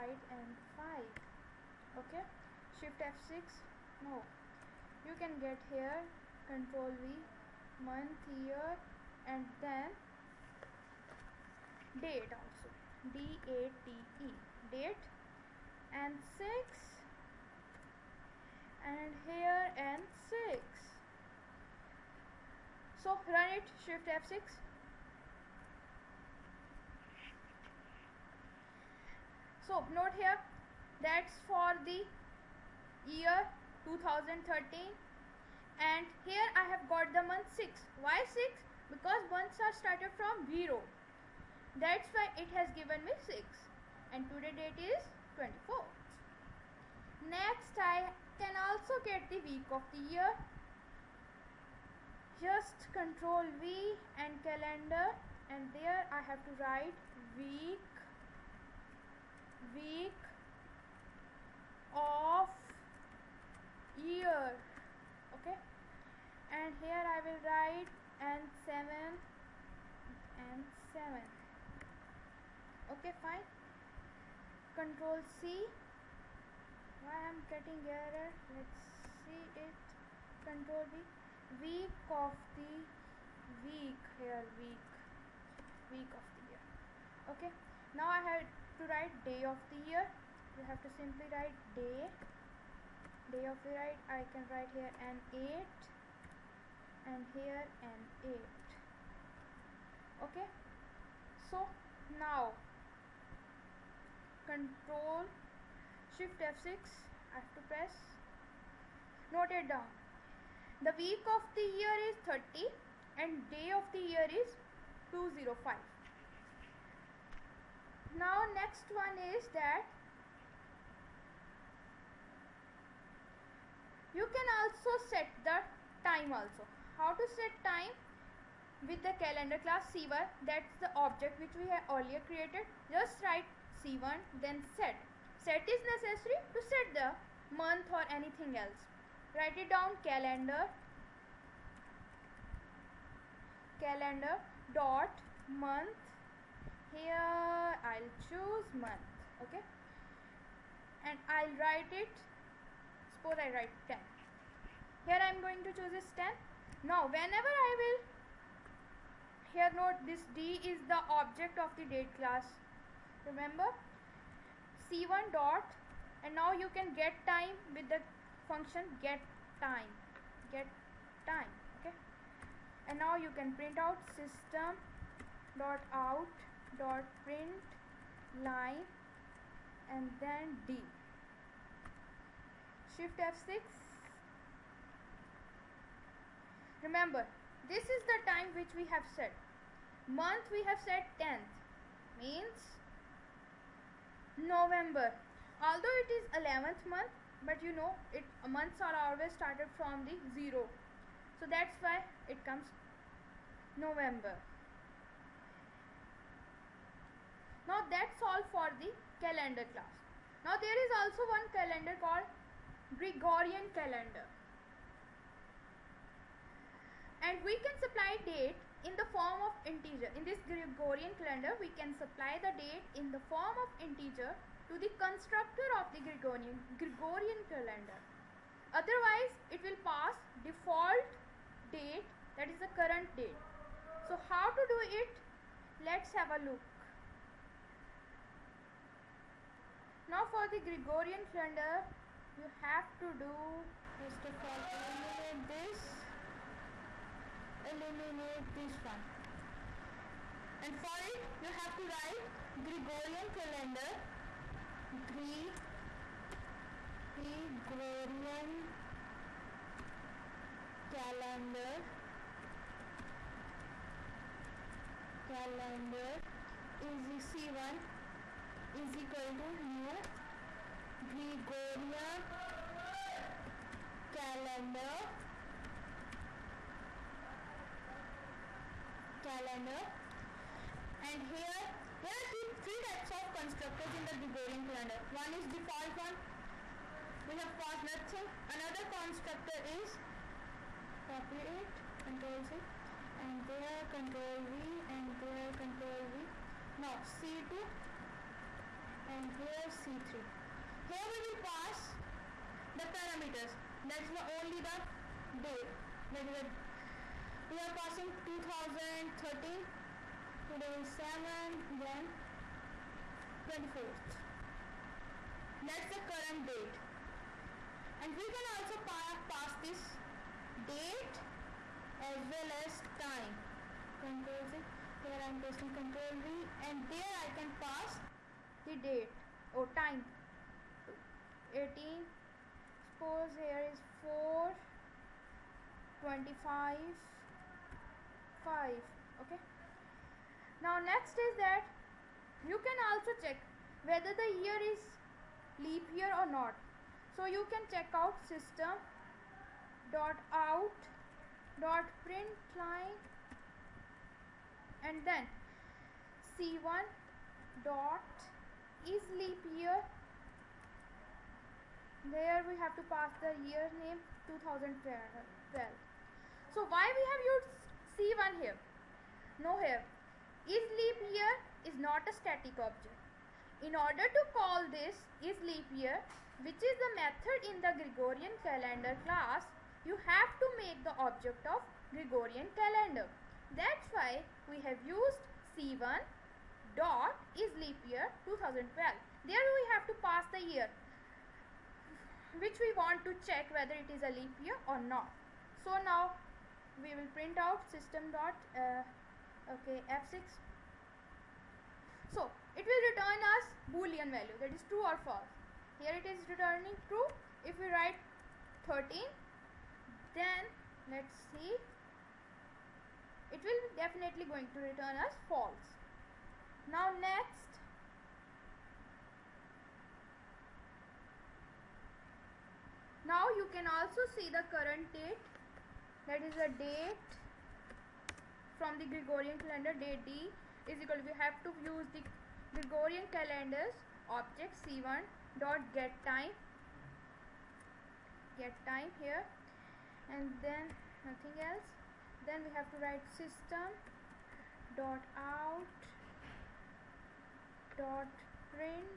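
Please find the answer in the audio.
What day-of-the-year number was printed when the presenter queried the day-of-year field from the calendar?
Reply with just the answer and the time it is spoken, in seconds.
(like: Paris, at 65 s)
205, at 113 s.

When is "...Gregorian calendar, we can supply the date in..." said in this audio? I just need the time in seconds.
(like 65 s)
220 s.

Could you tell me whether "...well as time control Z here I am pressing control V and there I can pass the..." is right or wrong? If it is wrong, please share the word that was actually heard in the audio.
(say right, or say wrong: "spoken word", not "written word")
right.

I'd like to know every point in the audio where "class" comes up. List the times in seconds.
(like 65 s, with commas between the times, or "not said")
129 s, 162 s, 209 s, 379 s.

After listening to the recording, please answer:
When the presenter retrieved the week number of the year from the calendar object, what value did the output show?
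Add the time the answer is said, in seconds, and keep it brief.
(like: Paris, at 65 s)
30, at 110 s.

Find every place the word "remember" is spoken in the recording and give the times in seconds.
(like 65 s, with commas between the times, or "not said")
163 s, 186 s.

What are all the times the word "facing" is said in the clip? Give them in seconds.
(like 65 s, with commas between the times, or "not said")
not said.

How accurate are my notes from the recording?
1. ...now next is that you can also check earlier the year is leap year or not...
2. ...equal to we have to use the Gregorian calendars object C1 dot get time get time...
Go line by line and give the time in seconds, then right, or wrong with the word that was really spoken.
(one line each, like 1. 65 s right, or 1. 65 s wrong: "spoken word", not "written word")
1. 340 s wrong: "whether", not "earlier"
2. 430 s right.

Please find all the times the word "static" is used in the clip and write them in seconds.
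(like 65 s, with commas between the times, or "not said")
372 s.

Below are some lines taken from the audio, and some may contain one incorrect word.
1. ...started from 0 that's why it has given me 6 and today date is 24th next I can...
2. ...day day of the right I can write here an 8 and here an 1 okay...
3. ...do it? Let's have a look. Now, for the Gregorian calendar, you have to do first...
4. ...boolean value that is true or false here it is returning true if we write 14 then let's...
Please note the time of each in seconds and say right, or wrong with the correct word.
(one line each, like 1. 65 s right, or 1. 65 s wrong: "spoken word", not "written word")
1. 39 s right
2. 91 s wrong: "8", not "1"
3. 234 s right
4. 403 s wrong: "13", not "14".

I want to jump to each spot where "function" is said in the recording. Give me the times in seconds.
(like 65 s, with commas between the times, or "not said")
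168 s.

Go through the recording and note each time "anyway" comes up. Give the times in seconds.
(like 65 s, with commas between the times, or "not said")
not said.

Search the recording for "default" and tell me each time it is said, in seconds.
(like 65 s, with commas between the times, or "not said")
230 s, 285 s.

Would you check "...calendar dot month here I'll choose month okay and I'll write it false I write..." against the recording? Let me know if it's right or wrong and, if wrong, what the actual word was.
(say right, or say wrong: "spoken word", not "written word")
wrong: "suppose", not "false".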